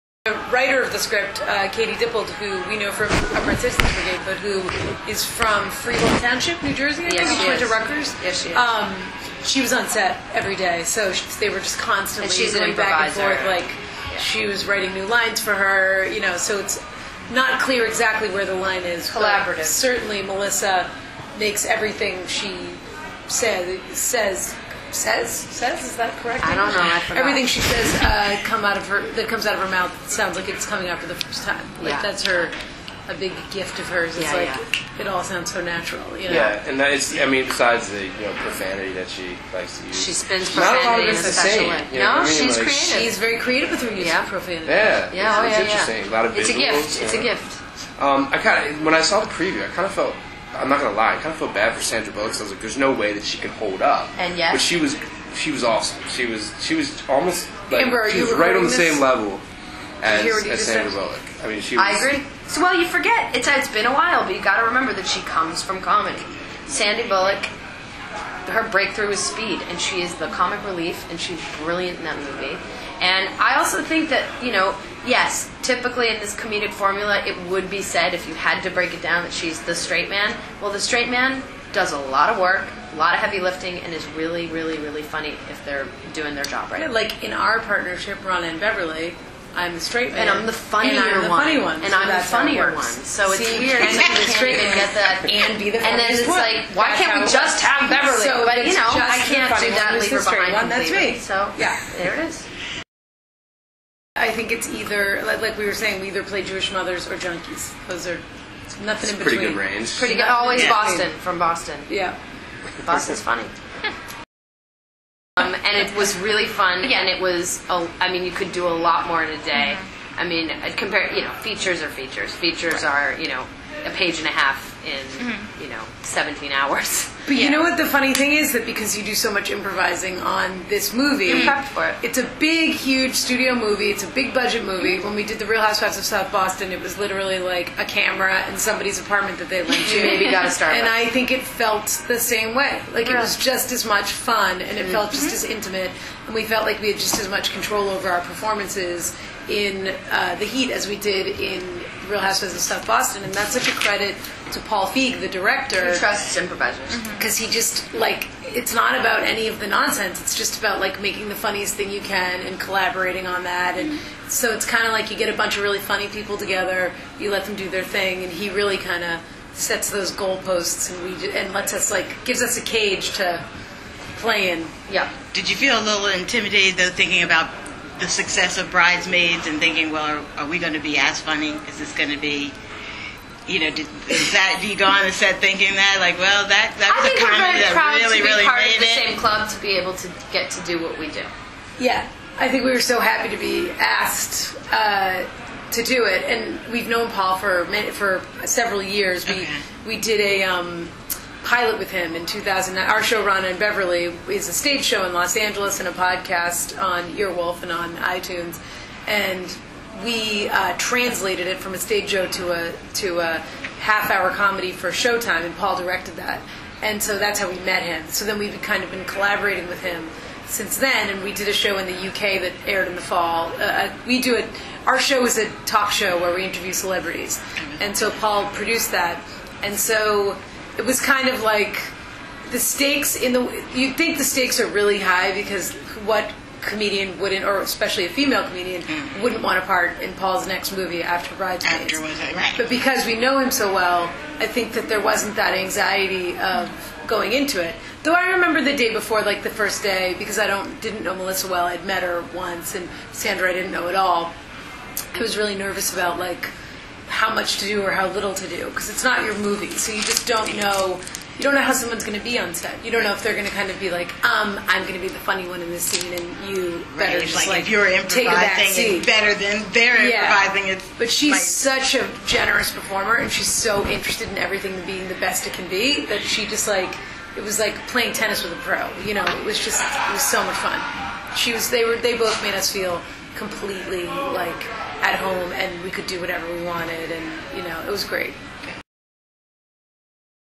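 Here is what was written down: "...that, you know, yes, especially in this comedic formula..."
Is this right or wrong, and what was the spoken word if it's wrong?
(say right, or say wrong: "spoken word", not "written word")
wrong: "typically", not "especially".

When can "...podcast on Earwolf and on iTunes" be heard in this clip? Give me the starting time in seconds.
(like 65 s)
205 s.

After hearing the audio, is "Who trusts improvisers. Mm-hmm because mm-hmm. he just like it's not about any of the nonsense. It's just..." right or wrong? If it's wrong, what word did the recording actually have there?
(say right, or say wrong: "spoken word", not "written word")
right.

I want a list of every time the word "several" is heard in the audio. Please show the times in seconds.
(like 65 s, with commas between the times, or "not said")
198 s.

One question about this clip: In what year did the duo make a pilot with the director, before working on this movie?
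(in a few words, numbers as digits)
2009.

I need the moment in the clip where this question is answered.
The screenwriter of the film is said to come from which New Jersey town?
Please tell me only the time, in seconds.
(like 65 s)
5 s.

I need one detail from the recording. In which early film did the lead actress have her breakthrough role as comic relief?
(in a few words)
Speed.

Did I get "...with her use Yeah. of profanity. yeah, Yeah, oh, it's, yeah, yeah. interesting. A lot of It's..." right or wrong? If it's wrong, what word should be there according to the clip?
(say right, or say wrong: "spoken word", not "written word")
right.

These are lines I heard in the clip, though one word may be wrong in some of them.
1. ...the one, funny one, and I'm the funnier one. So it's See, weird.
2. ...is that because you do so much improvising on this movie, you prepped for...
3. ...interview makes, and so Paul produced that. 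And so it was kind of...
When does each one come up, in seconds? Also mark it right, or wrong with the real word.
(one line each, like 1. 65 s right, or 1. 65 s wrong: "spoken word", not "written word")
1. 91 s right
2. 128 s right
3. 226 s wrong: "celebrities", not "makes".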